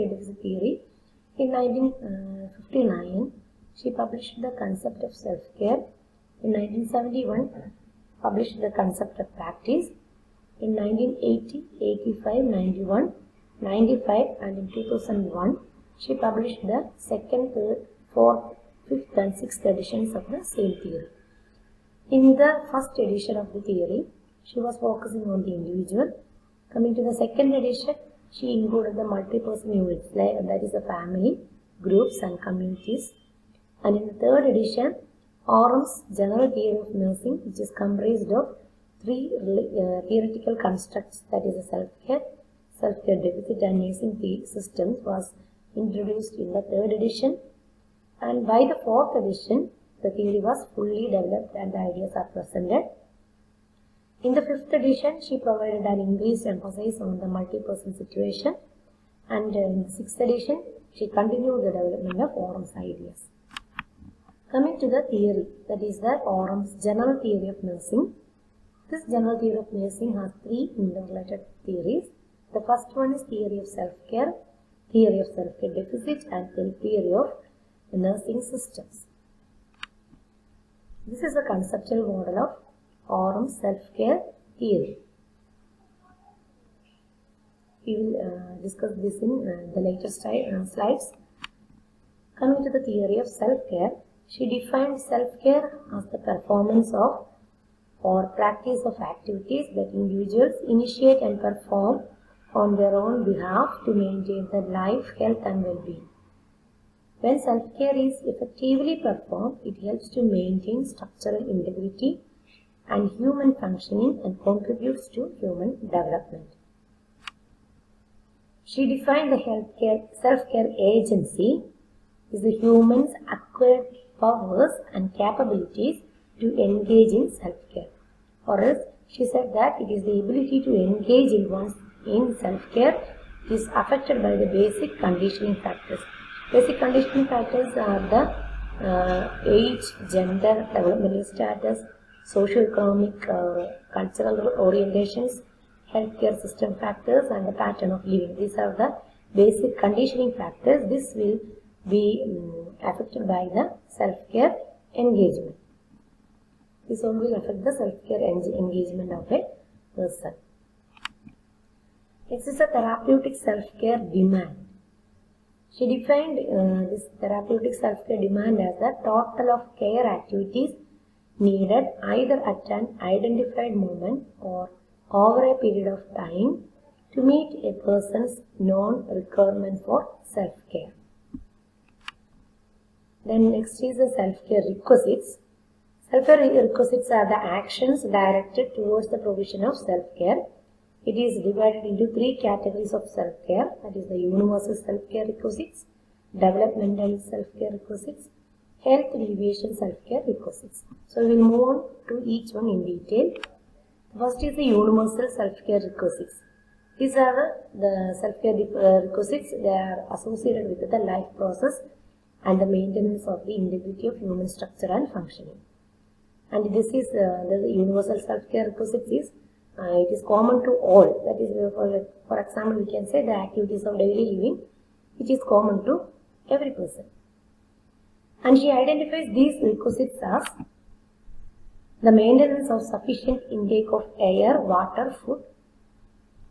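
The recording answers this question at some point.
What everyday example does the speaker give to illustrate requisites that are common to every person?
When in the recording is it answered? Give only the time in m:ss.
3:43.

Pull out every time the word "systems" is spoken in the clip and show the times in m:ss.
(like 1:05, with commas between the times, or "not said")
0:44, 1:18, 2:26.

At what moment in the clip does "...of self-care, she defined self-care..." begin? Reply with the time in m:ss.
1:33.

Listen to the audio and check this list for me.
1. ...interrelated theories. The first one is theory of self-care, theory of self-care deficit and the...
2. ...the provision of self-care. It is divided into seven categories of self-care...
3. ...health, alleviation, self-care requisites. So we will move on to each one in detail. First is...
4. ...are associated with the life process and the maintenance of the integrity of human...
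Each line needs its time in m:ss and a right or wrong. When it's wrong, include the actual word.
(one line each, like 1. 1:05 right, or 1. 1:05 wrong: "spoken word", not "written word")
1. 1:10 right
2. 3:09 wrong: "three", not "seven"
3. 3:18 right
4. 3:29 right.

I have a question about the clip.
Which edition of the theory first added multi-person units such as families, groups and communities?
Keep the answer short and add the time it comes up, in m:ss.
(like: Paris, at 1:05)
Second edition, at 0:27.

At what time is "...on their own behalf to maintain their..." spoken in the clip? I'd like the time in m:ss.
1:42.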